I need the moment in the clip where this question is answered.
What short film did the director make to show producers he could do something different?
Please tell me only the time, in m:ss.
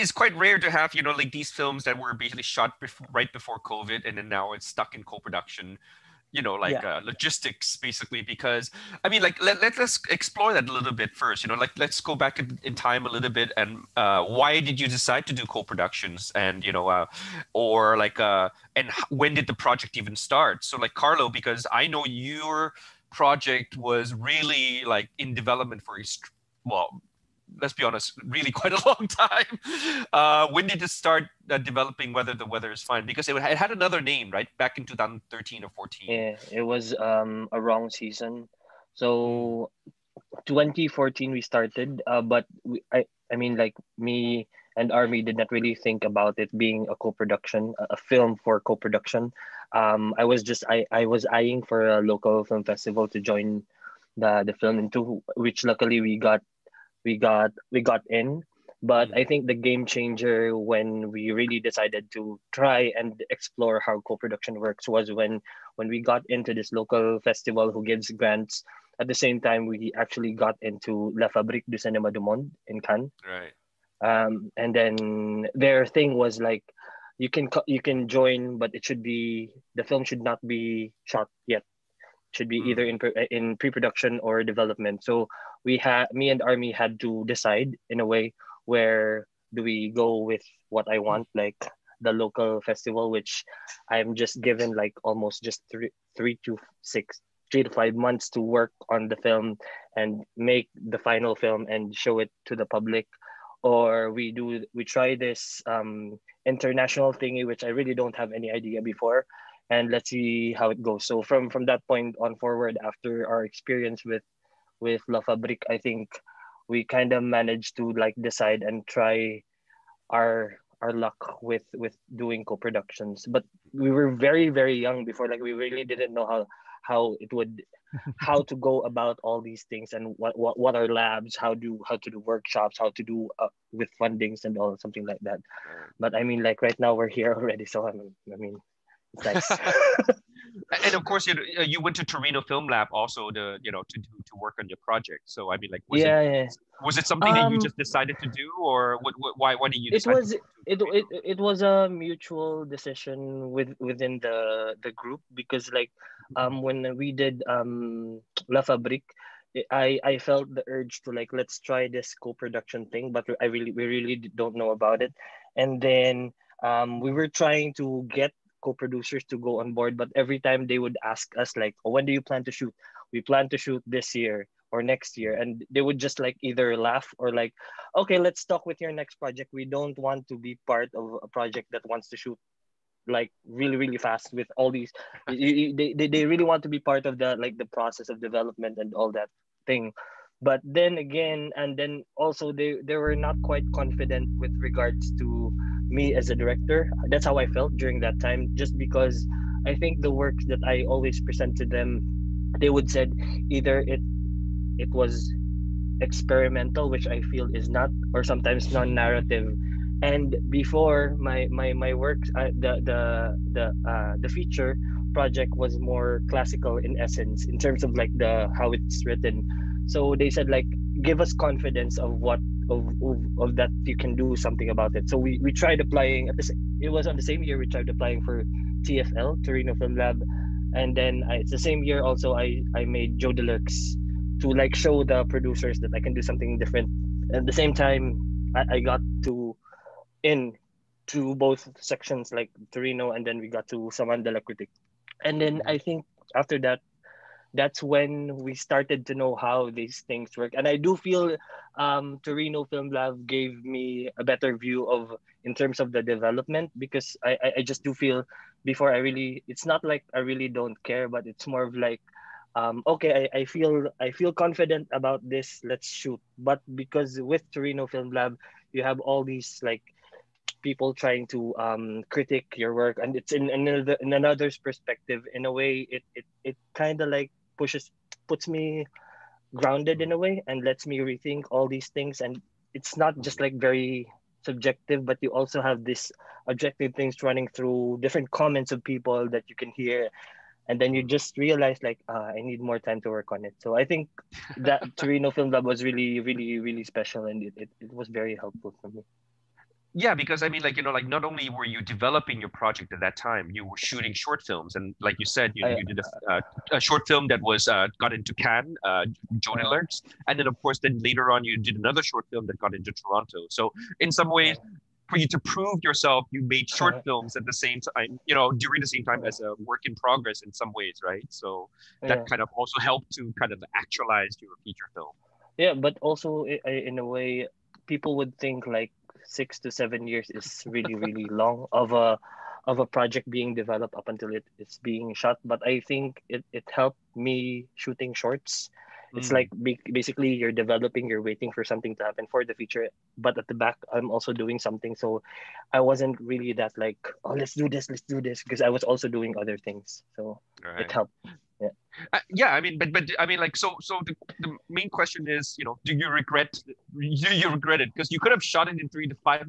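3:53.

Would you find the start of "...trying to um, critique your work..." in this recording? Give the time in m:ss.
4:30.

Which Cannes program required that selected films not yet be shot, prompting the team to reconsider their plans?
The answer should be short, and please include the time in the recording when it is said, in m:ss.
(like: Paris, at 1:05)
La Fabrique du Cinéma du Monde, at 1:11.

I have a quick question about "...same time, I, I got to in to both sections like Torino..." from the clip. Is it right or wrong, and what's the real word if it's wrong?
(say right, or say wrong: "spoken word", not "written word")
right.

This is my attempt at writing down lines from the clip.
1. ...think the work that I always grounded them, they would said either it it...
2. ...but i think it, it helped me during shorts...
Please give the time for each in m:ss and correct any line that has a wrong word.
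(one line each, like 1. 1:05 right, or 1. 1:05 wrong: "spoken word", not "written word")
1. 3:19 wrong: "presented", not "grounded"
2. 5:35 wrong: "shooting", not "during".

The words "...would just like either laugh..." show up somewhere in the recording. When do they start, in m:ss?
2:55.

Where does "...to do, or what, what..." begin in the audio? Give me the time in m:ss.
2:28.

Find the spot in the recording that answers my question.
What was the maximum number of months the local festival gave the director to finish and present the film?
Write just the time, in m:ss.
1:37.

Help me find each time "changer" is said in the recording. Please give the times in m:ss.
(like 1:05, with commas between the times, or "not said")
0:59.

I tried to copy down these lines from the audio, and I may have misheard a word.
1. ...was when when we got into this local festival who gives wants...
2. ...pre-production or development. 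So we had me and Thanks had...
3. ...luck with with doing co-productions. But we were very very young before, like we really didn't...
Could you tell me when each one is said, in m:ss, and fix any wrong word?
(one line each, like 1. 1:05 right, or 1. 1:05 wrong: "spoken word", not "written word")
1. 1:04 wrong: "grants", not "wants"
2. 1:23 wrong: "Armi", not "Thanks"
3. 2:00 right.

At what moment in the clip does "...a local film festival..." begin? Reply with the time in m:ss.
0:51.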